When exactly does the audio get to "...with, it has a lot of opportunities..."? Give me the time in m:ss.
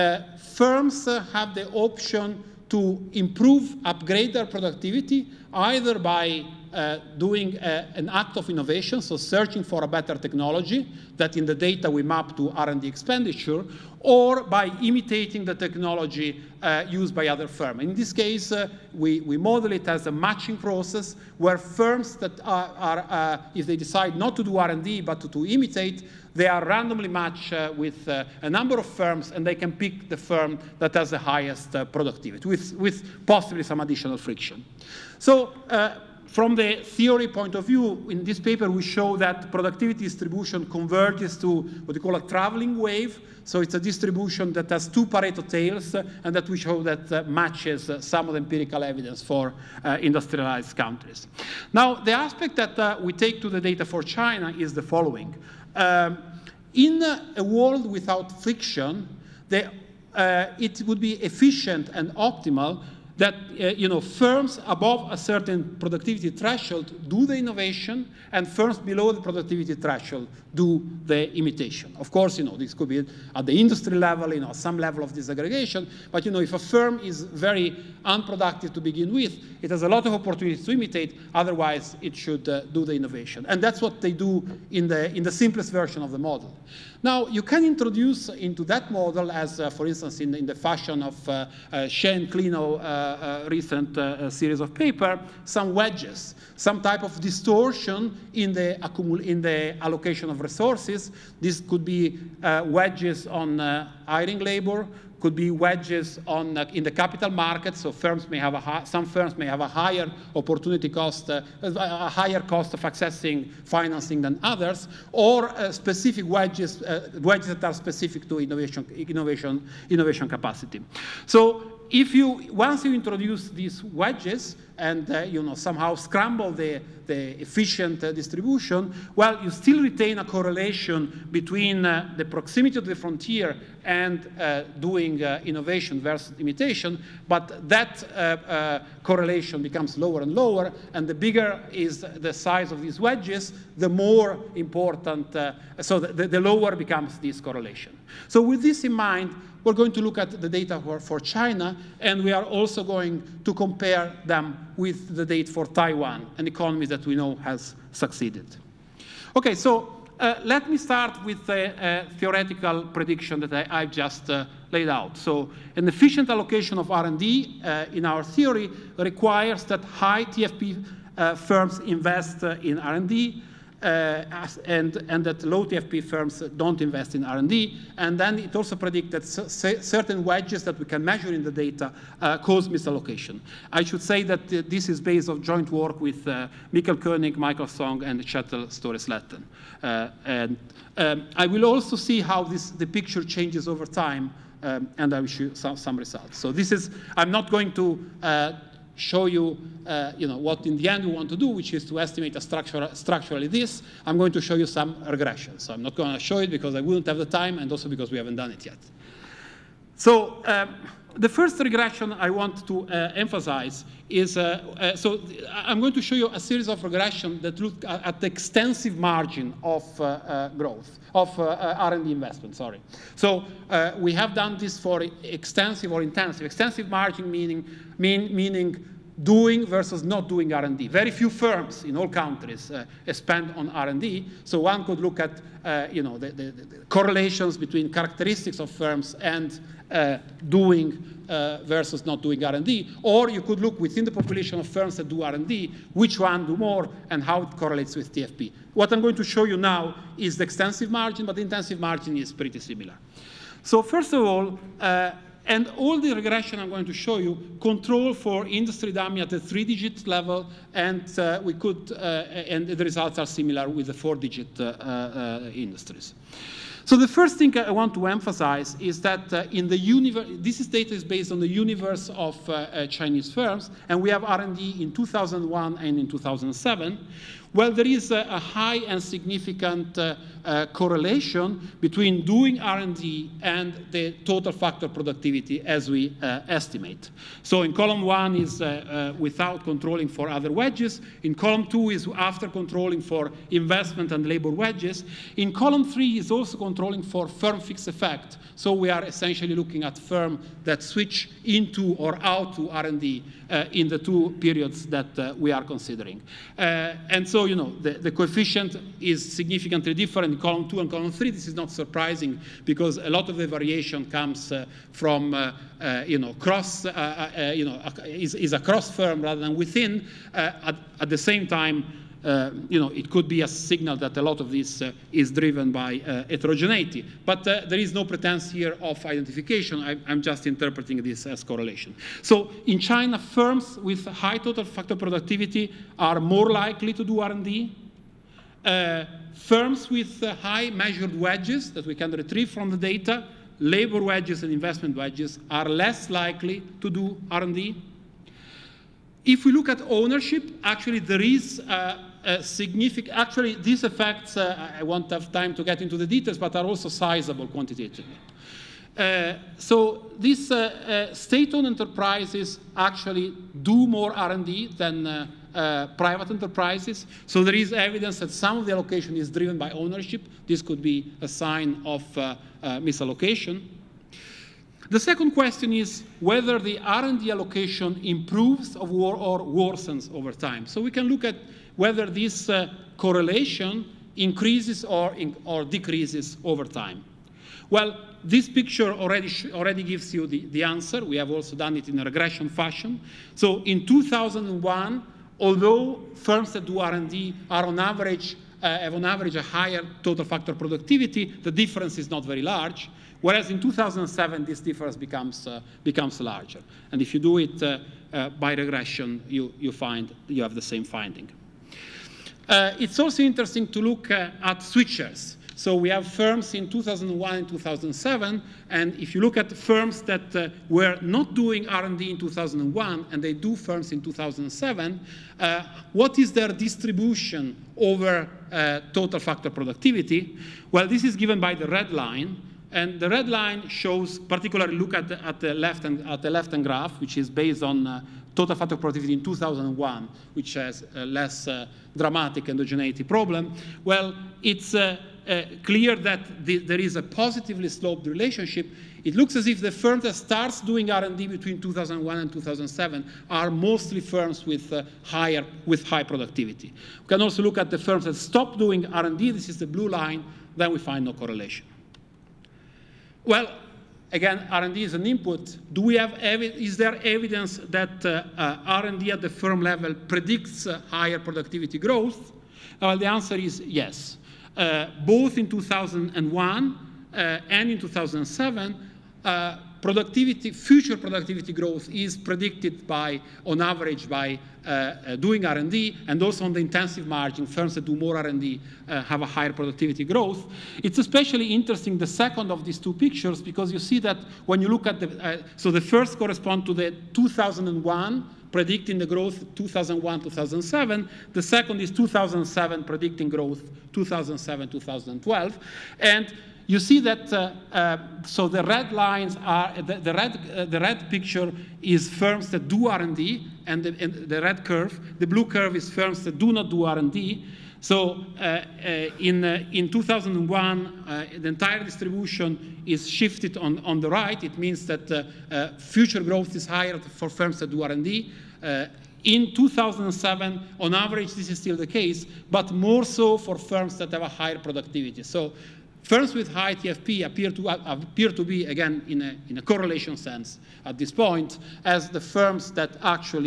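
1:19.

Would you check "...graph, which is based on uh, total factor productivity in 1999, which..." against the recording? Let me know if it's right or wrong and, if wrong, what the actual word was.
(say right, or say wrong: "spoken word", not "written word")
wrong: "2001", not "1999".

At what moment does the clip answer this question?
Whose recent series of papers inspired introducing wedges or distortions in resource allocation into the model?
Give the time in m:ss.
1:31.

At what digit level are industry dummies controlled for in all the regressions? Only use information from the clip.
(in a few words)
three-digit.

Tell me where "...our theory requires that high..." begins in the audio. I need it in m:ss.
2:48.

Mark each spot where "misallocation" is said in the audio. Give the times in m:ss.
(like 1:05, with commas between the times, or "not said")
3:02, 6:12.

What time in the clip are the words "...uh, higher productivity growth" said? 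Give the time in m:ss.
7:50.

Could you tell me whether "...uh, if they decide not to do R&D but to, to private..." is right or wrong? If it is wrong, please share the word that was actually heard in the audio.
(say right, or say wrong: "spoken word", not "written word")
wrong: "imitate", not "private".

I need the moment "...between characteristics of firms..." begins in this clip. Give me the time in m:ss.
3:57.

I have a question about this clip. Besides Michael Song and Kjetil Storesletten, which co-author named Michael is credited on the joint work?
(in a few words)
Michael Koenig.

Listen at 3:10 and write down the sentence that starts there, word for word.
and um, I will also see how this, the picture changes over time um, and I will show some, some results.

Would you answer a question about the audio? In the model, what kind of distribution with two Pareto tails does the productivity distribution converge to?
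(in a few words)
traveling wave.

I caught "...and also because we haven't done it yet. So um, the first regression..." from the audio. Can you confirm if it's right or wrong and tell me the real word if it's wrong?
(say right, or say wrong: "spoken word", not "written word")
right.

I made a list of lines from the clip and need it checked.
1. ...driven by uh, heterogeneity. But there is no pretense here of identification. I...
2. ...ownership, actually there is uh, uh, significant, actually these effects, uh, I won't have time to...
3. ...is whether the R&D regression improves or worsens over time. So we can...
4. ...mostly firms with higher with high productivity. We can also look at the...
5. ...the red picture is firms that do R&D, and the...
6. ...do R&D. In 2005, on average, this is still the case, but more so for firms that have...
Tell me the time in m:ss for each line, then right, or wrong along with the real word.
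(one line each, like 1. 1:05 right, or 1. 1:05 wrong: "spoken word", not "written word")
1. 5:25 right
2. 5:49 right
3. 6:15 wrong: "allocation", not "regression"
4. 7:33 right
5. 8:30 right
6. 8:47 wrong: "2007", not "2005".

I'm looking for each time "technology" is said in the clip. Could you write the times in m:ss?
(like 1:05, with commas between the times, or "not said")
0:10, 0:15.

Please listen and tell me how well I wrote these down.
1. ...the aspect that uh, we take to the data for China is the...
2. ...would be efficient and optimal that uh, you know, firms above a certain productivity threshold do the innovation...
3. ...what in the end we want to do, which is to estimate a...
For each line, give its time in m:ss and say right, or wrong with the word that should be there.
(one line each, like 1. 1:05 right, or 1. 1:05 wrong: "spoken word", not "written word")
1. 0:51 right
2. 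1:00 right
3. 3:20 right.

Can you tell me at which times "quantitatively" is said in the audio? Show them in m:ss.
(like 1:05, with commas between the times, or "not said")
5:57.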